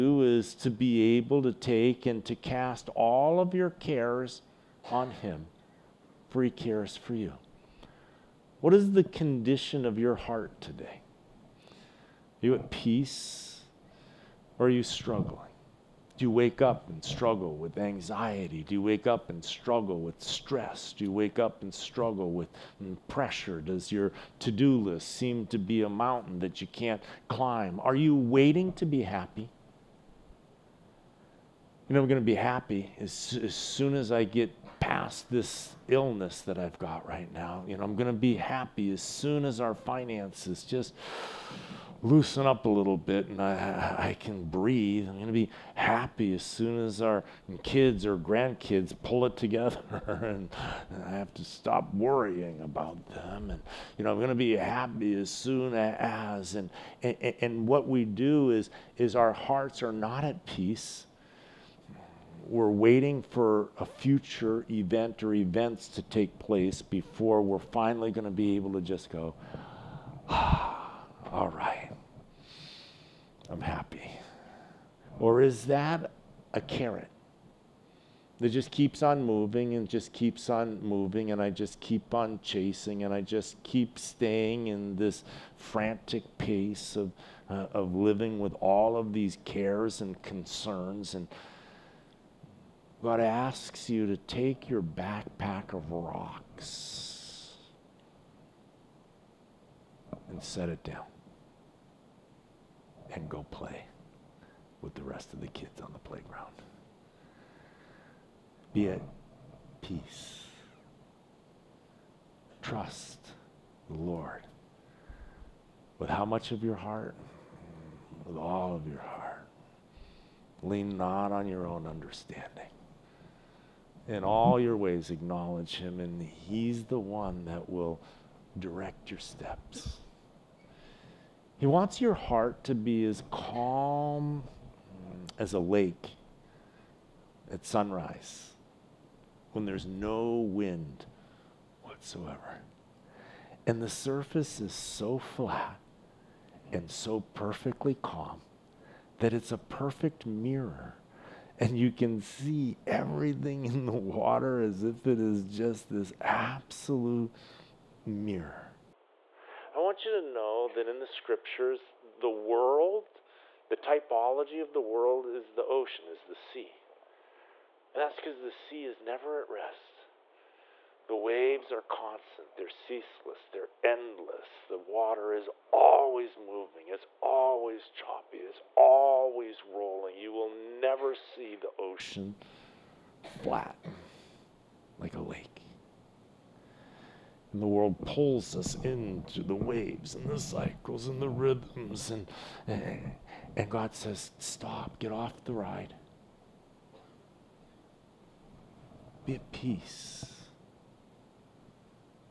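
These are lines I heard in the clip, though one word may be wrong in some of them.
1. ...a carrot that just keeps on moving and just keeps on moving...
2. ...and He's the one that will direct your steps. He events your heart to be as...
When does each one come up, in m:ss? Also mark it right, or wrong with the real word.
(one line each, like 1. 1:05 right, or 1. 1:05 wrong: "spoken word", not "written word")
1. 1:16 right
2. 2:05 wrong: "wants", not "events".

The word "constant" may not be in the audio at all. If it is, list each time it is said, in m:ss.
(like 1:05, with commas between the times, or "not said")
2:51.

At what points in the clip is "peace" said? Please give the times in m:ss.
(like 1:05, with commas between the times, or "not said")
0:12, 1:00, 1:49, 3:19.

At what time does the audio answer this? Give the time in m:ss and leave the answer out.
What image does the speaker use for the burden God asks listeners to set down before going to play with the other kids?
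1:34.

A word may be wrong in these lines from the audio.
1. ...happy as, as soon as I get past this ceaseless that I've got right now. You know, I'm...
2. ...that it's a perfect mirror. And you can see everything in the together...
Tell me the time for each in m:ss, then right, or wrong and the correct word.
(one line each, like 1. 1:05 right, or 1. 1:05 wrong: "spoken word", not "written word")
1. 0:32 wrong: "illness", not "ceaseless"
2. 2:29 wrong: "water", not "together".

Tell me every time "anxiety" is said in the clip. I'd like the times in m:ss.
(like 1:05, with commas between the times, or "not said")
0:17.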